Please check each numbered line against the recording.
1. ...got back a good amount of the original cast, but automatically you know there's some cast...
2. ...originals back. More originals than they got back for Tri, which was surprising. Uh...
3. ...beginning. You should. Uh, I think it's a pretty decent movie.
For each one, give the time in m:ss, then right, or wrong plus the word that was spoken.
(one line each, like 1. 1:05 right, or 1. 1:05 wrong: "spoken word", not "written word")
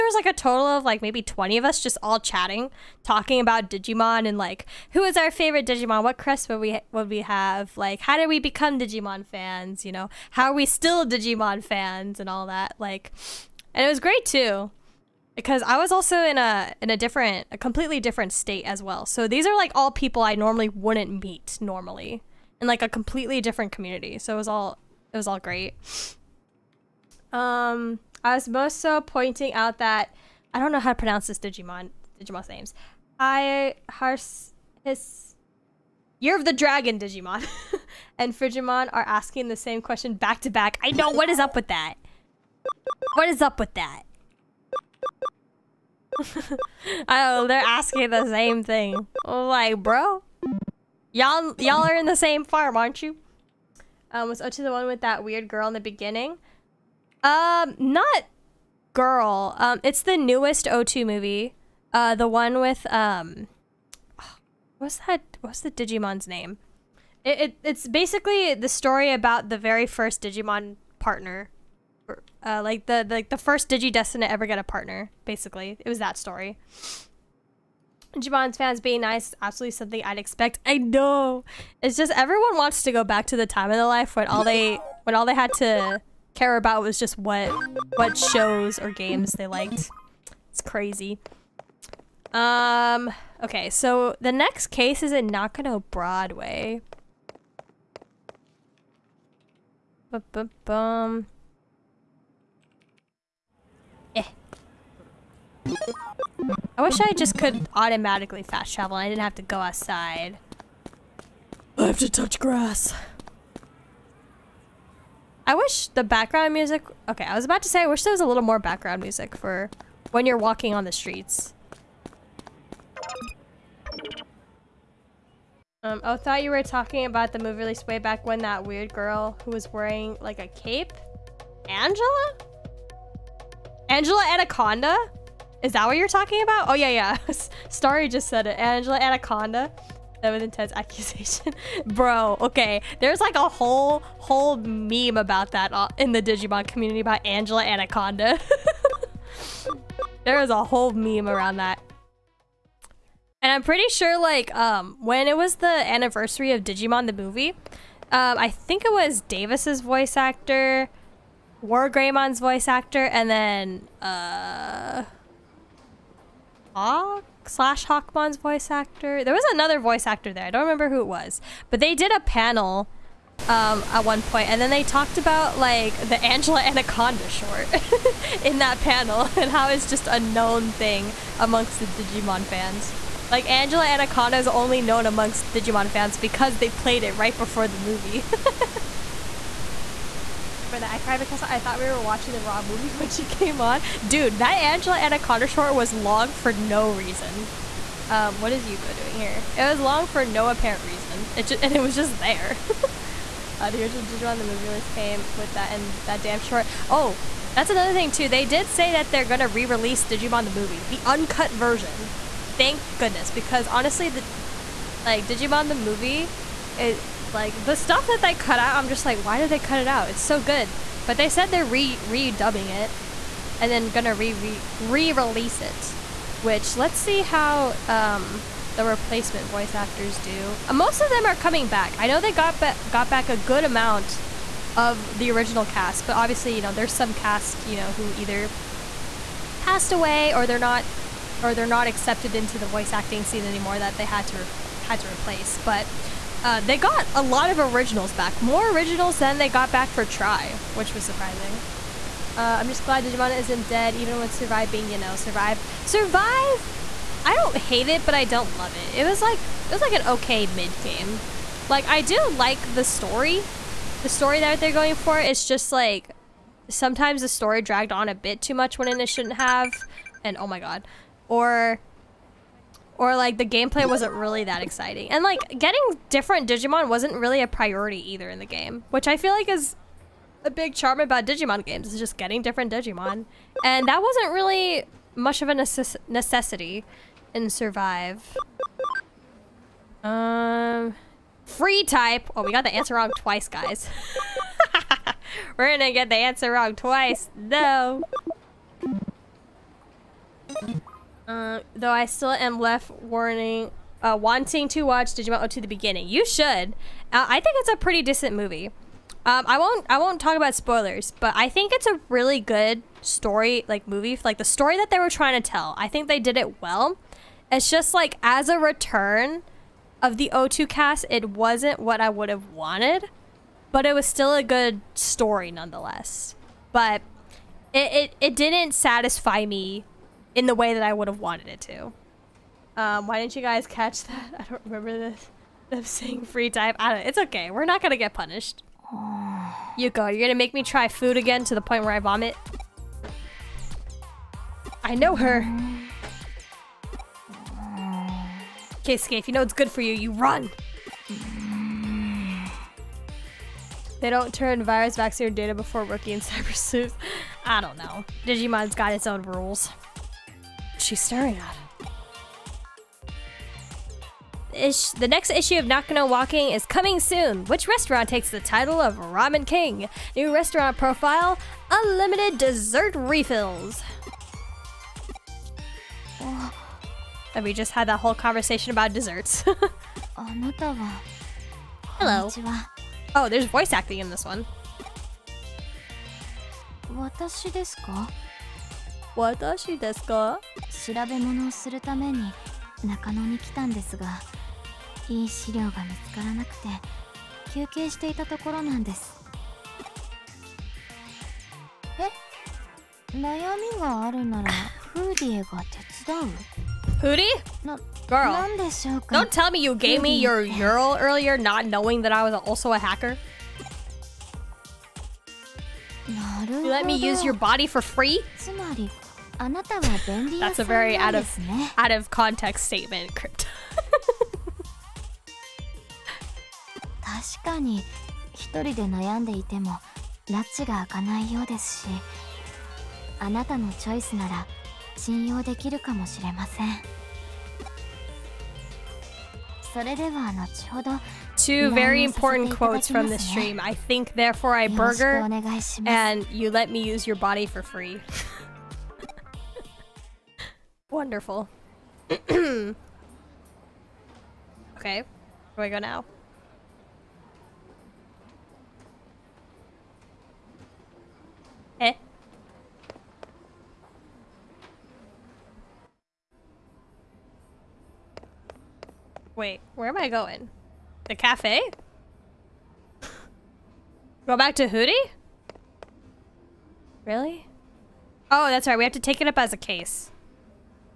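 1. 3:52 wrong: "obviously", not "automatically"
2. 4:07 right
3. 5:05 right.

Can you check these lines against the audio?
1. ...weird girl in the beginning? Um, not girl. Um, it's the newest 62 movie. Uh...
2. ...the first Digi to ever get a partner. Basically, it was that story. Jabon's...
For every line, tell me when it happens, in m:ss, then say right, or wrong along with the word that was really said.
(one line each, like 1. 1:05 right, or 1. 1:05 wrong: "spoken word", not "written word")
1. 0:55 wrong: "02", not "62"
2. 1:13 right.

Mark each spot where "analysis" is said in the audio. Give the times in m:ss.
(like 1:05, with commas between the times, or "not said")
not said.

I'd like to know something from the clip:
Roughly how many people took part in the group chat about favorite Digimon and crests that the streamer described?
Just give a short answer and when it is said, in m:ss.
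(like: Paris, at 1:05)
20, at 0:01.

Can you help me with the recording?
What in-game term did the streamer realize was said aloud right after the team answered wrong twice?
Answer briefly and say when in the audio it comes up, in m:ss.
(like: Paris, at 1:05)
free time, at 5:36.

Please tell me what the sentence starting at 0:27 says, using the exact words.
Um, I was also pointing out that I don't know how to pronounce this Digimon Digimon's names.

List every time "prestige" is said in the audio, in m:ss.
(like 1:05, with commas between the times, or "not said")
not said.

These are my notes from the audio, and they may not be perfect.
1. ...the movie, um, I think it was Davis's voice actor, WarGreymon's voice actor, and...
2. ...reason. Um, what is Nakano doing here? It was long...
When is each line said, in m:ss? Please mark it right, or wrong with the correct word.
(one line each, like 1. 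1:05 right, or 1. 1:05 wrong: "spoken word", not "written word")
1. 2:37 right
2. 3:16 wrong: "Yuuko", not "Nakano".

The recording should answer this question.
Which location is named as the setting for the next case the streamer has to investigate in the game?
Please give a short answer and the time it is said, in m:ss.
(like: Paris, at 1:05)
Nakano Broadway, at 1:35.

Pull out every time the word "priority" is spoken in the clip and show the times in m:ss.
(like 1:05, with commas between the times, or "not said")
4:37.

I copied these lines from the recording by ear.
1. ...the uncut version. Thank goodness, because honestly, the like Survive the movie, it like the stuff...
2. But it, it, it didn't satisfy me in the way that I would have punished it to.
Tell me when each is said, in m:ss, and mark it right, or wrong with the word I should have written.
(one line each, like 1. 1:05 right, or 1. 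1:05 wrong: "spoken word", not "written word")
1. 3:30 wrong: "Digimon", not "Survive"
2. 5:26 wrong: "wanted", not "punished".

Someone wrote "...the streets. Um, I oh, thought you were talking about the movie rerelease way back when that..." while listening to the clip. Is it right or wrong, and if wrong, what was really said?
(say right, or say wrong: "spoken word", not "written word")
wrong: "release", not "rerelease".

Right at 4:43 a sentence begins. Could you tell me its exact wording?
And that wasn't really much of a necess necessity in Survive.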